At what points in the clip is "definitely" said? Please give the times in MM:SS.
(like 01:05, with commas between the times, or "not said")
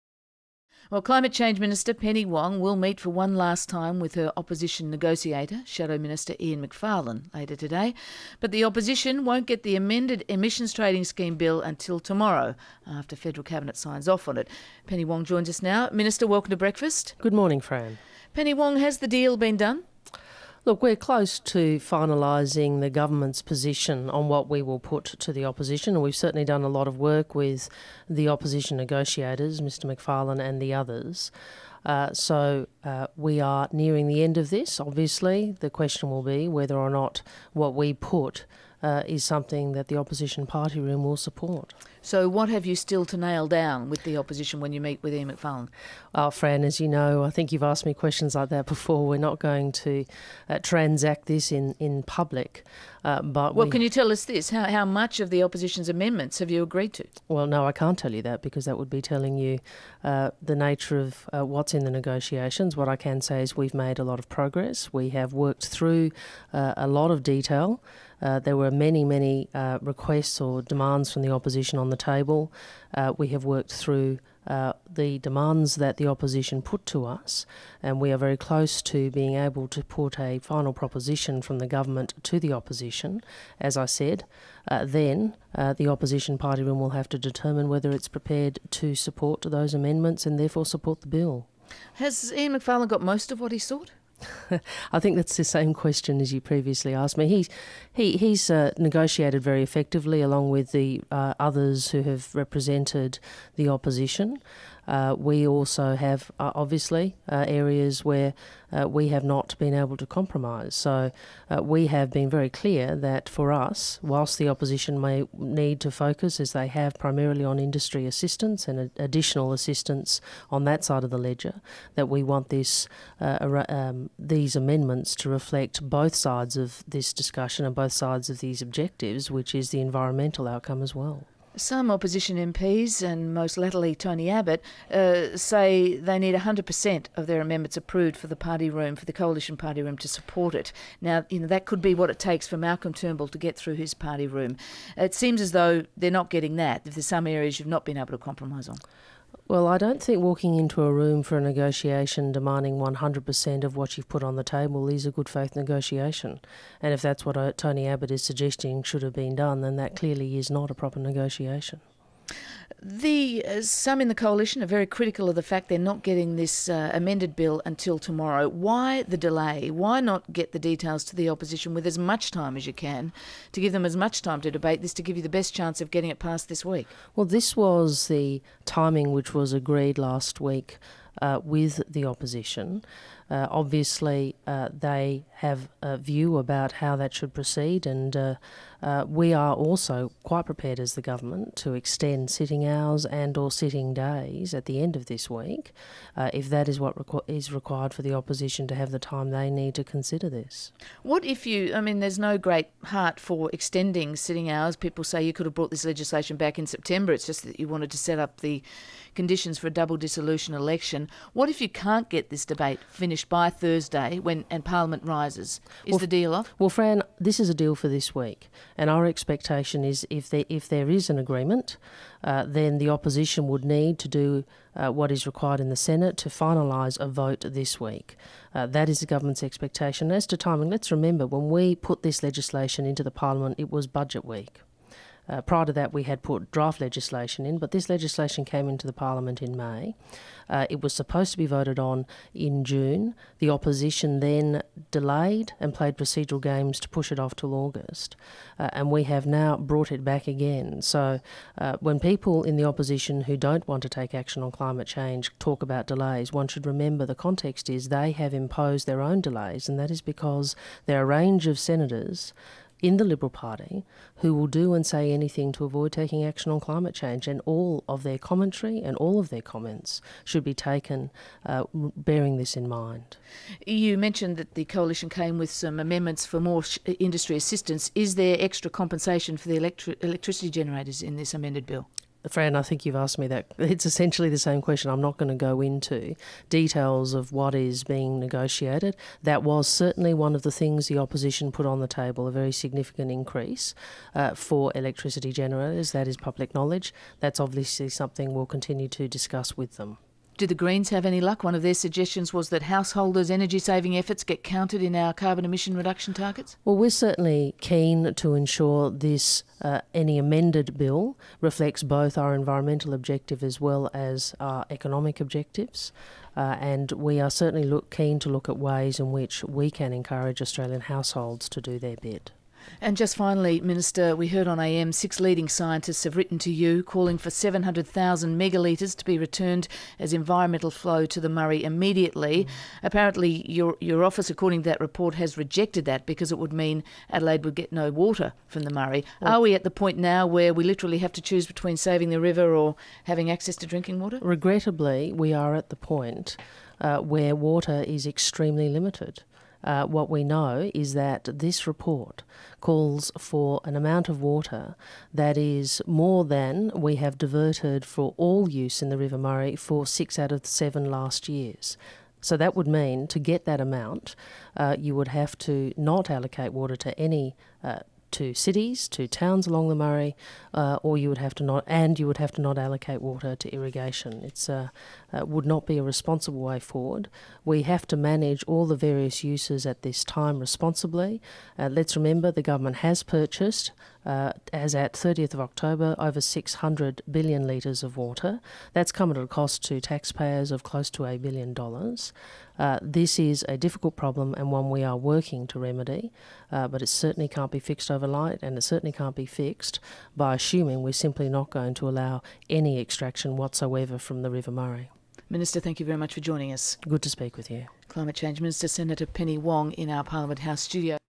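not said.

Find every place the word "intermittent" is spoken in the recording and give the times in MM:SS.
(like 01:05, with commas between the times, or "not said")
not said.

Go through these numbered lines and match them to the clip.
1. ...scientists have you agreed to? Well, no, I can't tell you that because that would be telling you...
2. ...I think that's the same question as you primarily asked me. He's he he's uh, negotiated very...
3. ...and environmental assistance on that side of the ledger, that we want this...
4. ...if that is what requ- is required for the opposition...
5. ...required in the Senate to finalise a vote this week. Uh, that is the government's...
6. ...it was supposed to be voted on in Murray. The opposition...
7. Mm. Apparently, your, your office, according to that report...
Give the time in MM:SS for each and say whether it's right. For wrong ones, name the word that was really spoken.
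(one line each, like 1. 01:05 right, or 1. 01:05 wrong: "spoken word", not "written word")
1. 00:55 wrong: "amendments", not "scientists"
2. 01:34 wrong: "previously", not "primarily"
3. 01:58 wrong: "additional", not "environmental"
4. 03:16 right
5. 03:45 right
6. 04:00 wrong: "June", not "Murray"
7. 05:32 right.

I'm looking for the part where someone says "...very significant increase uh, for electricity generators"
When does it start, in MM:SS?
04:52.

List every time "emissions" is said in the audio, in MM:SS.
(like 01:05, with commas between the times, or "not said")
00:10, 05:05.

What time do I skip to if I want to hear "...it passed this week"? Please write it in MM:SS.
02:56.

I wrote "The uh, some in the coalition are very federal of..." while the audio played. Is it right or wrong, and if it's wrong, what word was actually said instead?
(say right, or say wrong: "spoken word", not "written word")
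wrong: "critical", not "federal".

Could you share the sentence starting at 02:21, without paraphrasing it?
Now, you know, that could be what it takes for Malcolm Turnbull to get through his party room.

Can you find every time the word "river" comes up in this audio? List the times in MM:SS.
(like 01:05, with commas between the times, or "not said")
05:42, 05:58, 06:44.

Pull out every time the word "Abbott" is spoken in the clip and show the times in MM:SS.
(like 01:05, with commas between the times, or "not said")
02:14, 02:37.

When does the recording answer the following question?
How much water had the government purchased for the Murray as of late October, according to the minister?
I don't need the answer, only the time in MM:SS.
06:26.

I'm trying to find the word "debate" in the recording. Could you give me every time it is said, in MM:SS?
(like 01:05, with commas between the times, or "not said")
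02:54, 03:32.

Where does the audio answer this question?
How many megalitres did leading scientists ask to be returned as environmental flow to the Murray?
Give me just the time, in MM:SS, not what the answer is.
05:27.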